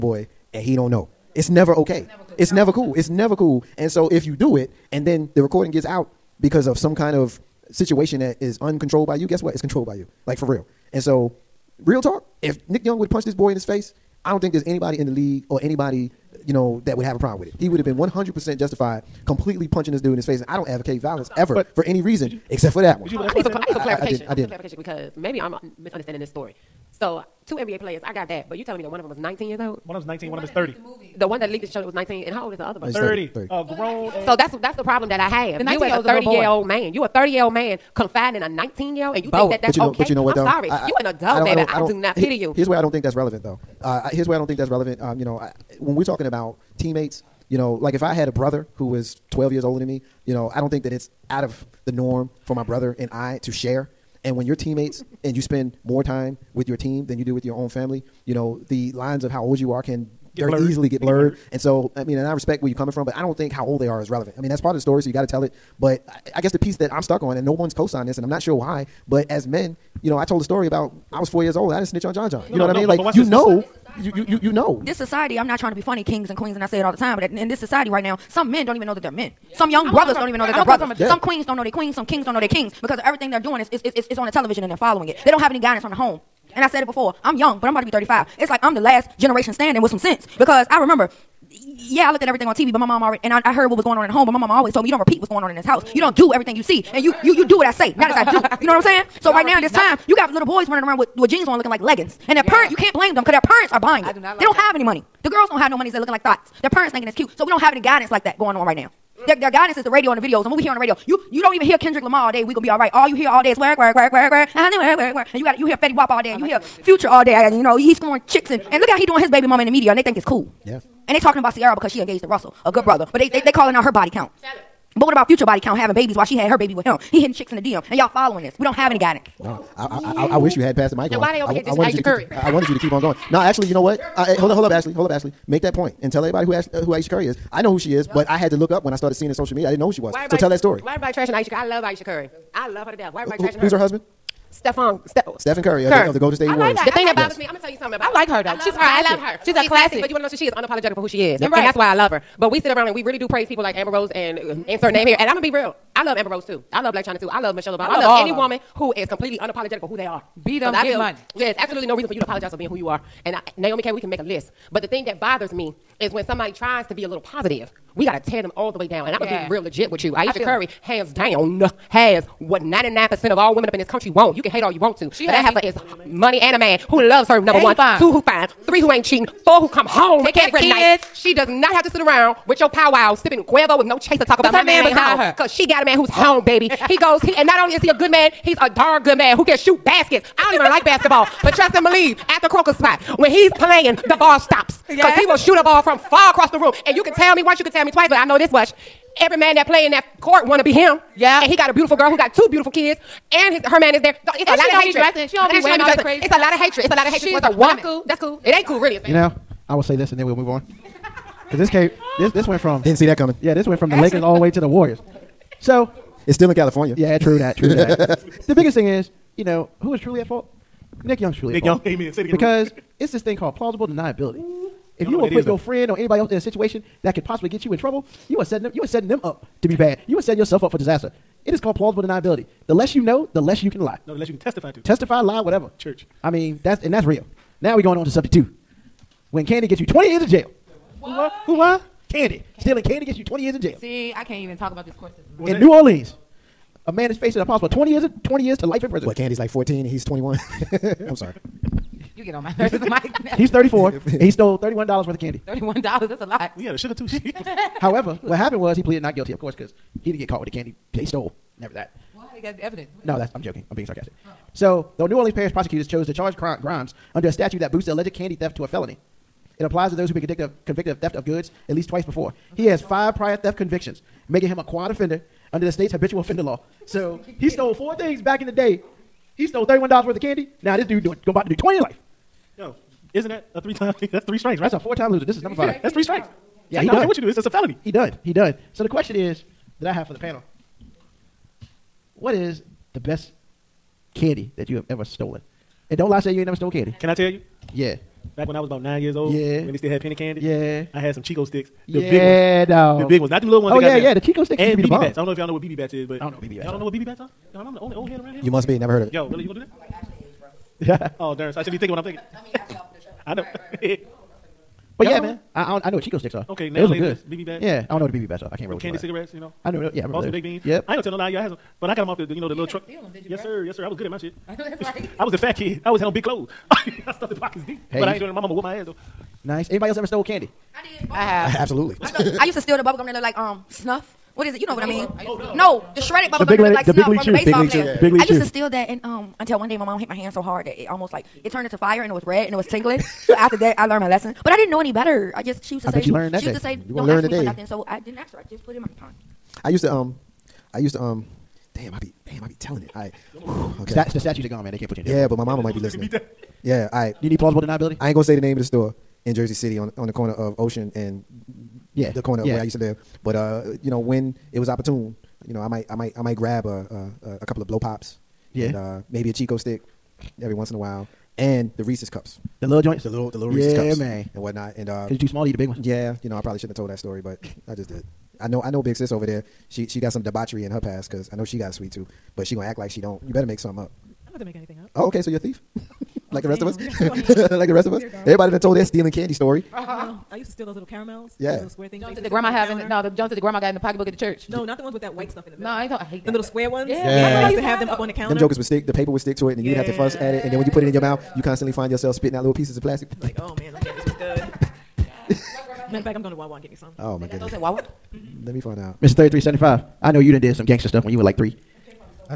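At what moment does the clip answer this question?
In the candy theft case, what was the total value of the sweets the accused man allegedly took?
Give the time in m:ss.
4:14.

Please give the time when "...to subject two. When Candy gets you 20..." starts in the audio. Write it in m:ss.
3:58.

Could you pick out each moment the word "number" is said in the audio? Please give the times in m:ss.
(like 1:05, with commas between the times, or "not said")
2:57, 4:45.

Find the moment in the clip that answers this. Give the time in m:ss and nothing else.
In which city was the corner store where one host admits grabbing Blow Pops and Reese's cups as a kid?
5:59.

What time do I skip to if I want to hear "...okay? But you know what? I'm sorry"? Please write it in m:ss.
0:39.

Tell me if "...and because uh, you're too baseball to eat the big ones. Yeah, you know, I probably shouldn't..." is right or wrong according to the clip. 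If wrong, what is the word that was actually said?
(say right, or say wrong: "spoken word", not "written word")
wrong: "small", not "baseball".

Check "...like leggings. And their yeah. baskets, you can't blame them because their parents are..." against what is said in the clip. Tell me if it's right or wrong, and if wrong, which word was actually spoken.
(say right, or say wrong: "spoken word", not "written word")
wrong: "parents", not "baskets".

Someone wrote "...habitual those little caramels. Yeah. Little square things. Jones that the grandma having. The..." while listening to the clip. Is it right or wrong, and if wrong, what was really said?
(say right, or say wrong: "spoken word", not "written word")
wrong: "steal", not "habitual".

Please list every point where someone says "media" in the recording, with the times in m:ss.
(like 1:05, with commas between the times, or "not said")
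1:59, 2:19.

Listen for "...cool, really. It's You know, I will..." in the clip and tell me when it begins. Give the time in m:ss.
3:28.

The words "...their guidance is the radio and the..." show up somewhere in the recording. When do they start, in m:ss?
1:49.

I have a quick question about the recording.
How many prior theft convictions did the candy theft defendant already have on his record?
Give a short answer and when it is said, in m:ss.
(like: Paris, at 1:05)
5, at 4:32.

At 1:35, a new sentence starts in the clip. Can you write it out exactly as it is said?
You don't do everything you see, and you, you, you do what I say, not as I do.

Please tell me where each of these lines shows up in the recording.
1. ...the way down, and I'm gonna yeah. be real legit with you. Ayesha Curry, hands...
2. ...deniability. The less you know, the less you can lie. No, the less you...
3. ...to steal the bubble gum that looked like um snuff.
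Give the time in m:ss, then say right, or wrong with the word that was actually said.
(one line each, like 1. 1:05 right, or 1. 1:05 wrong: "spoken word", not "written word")
1. 2:48 right
2. 3:52 right
3. 5:32 right.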